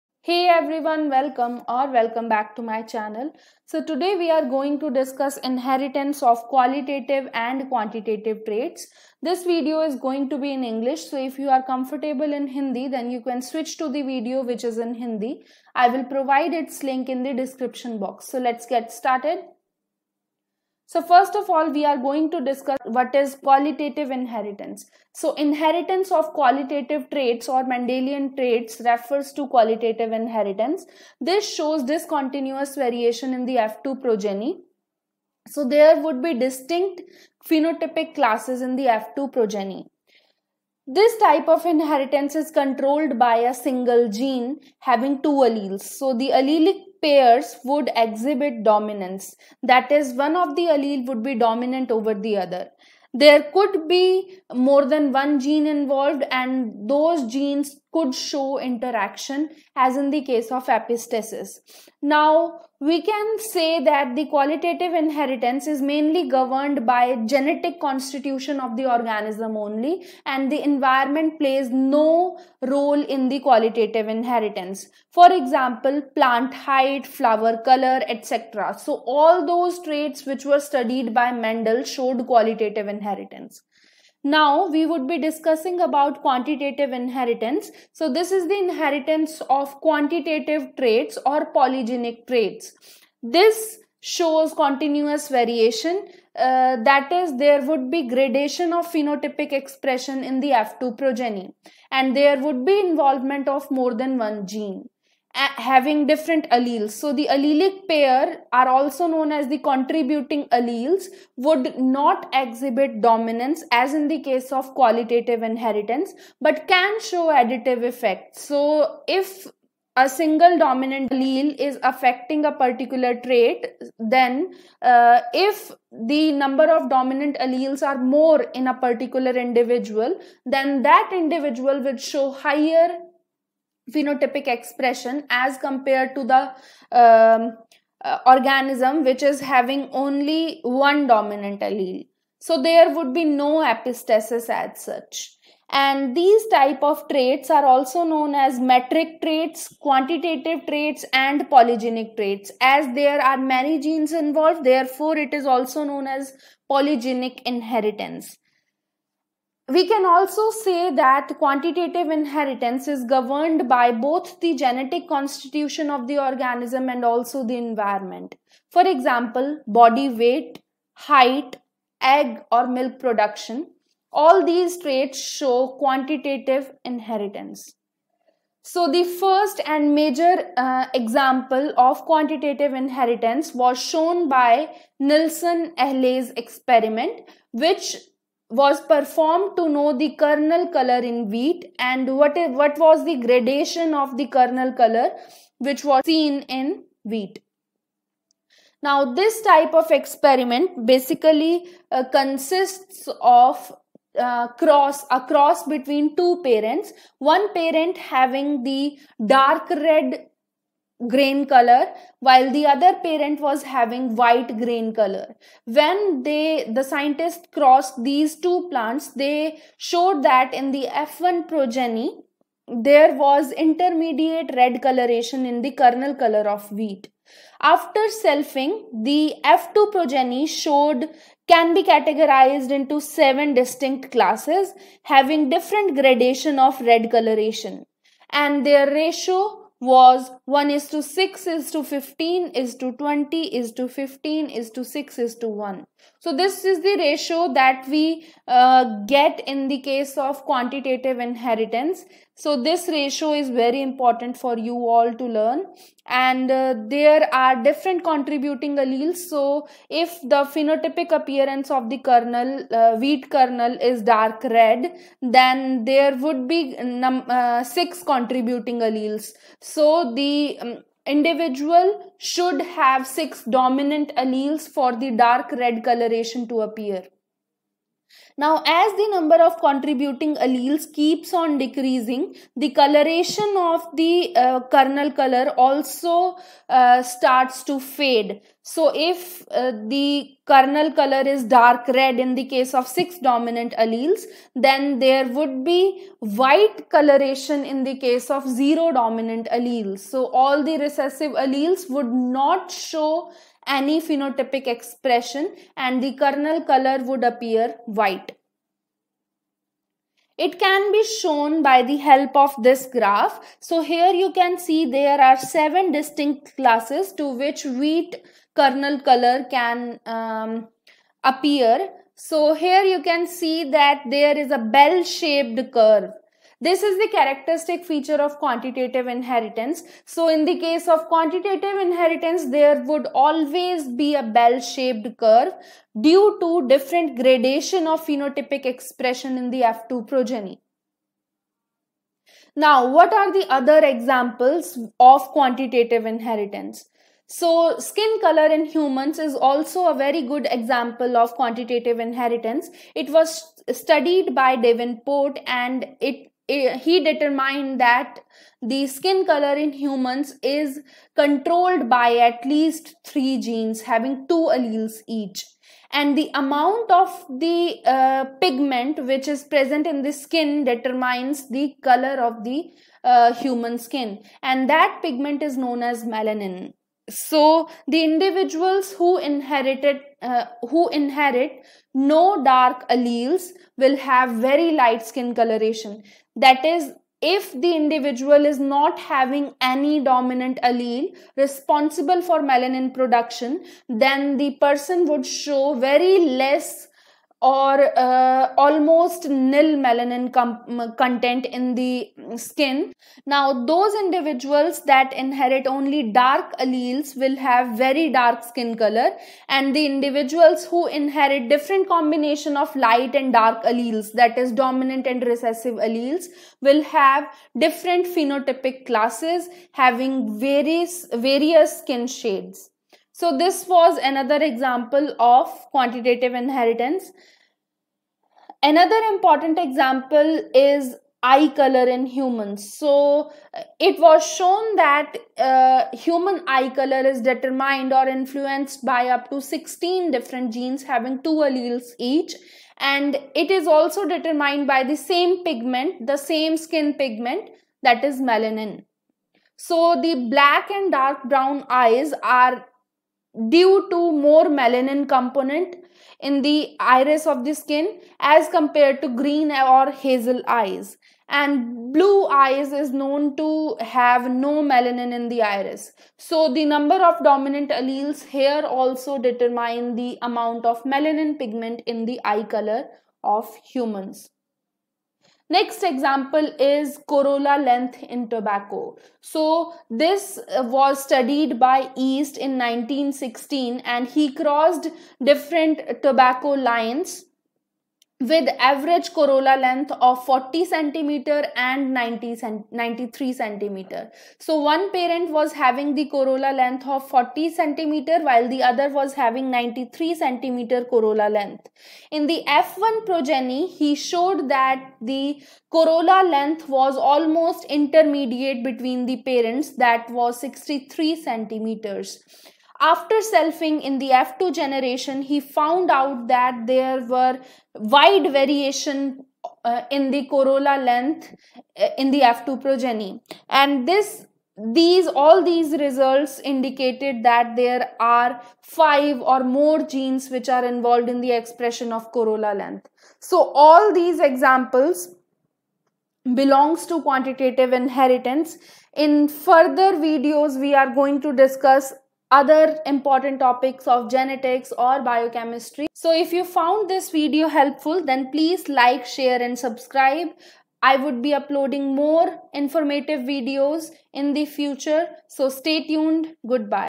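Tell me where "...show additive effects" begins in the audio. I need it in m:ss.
1:56.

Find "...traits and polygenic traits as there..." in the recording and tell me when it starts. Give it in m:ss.
2:30.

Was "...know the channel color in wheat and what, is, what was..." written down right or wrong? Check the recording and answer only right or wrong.
wrong.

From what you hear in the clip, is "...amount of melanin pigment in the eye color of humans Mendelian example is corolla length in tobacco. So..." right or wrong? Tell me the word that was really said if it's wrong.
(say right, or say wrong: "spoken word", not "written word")
wrong: "Next", not "Mendelian".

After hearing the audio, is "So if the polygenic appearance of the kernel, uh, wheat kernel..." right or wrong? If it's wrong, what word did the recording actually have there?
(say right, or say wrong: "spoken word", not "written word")
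wrong: "phenotypic", not "polygenic".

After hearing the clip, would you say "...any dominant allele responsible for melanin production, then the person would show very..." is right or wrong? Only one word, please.
right.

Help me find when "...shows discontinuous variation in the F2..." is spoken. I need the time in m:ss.
0:31.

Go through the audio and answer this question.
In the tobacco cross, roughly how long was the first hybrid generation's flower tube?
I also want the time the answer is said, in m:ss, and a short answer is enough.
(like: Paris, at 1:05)
63, at 8:30.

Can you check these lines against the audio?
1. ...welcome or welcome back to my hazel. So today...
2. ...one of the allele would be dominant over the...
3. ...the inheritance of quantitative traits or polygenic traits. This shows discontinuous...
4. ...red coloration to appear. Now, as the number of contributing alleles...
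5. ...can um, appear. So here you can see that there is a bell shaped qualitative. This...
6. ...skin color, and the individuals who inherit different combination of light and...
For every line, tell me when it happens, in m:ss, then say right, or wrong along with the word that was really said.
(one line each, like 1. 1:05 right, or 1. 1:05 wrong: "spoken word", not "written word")
1. 0:01 wrong: "channel", not "hazel"
2. 0:50 right
3. 1:28 wrong: "continuous", not "discontinuous"
4. 4:35 right
5. 5:19 wrong: "curve", not "qualitative"
6. 6:48 right.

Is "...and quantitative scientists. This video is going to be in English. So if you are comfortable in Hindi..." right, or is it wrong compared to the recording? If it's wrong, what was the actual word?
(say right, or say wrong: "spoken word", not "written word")
wrong: "traits", not "scientists".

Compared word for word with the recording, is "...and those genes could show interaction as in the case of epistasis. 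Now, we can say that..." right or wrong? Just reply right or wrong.
right.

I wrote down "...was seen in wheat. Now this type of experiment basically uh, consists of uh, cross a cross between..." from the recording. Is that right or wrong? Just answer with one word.
right.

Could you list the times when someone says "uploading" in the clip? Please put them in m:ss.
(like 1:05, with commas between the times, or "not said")
9:11.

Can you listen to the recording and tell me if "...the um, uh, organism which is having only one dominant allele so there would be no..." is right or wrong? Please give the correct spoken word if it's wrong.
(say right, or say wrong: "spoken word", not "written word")
right.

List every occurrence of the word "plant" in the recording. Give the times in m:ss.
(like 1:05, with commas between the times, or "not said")
1:16, 3:38.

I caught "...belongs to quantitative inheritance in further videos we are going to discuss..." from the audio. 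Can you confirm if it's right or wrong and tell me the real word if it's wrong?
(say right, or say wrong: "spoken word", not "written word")
right.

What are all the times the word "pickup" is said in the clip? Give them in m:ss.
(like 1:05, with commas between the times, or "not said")
not said.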